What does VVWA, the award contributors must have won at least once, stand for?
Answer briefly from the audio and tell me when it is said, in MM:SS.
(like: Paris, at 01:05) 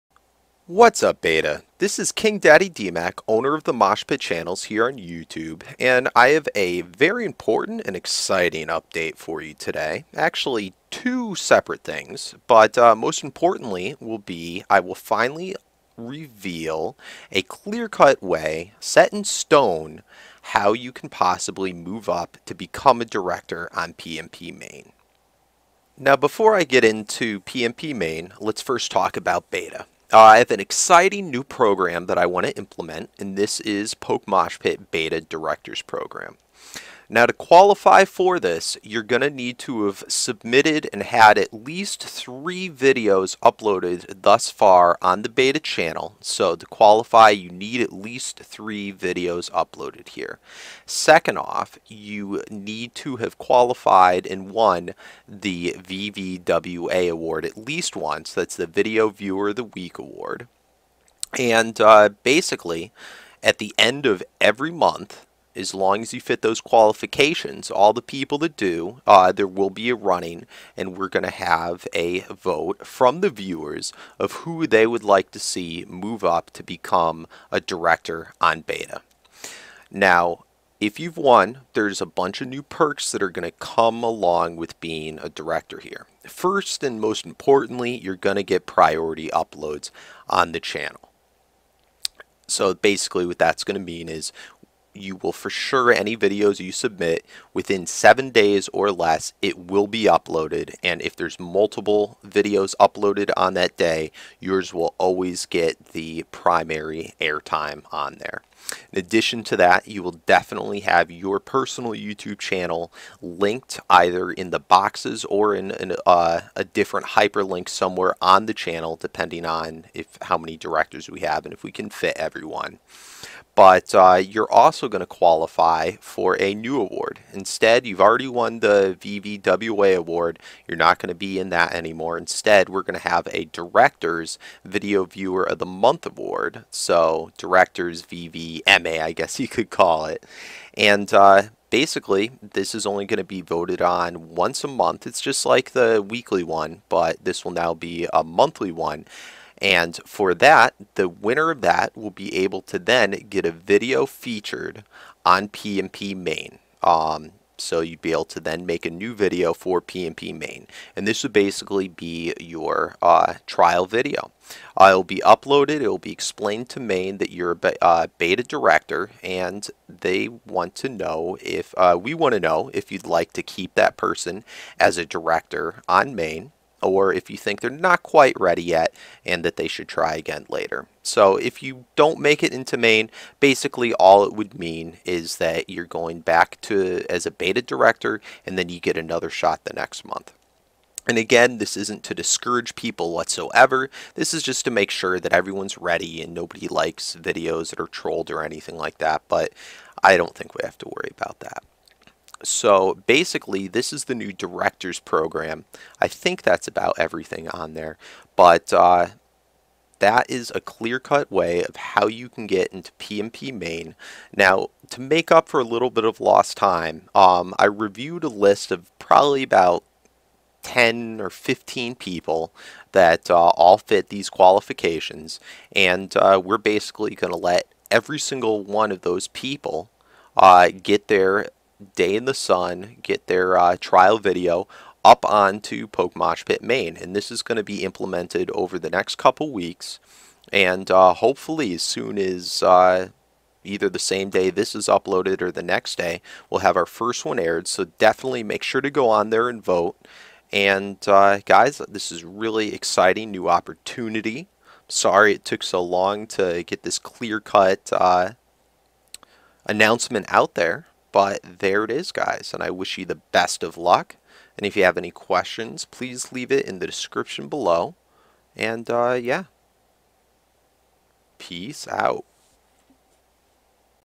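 Video Viewer of the Week, at 00:58.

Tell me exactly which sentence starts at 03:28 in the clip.
But uh, that is a clear-cut way of how you can get into PMP main.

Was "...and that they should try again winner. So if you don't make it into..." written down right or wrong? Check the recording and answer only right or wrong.
wrong.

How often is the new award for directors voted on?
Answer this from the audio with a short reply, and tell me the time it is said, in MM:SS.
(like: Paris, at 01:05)
Once a month, at 02:24.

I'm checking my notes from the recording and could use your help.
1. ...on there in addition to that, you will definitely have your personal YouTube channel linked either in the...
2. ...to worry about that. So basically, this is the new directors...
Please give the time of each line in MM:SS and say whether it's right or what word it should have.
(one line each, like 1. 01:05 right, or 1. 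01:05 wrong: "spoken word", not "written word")
1. 01:47 right
2. 03:20 right.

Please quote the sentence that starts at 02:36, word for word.
Um, so you'd be able to then make a new video for PMP main.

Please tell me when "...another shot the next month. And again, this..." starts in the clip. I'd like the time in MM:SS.
03:08.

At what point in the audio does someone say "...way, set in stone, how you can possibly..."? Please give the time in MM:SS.
00:18.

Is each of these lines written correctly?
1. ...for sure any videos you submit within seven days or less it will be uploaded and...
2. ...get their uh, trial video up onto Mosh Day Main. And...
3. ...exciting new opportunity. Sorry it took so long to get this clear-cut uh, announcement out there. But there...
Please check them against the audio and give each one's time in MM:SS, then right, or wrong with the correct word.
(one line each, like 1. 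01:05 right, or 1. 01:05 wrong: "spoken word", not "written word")
1. 01:35 right
2. 03:53 wrong: "Pit", not "Day"
3. 04:12 right.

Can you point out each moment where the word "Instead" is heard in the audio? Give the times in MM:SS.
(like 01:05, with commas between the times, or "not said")
02:07, 02:12.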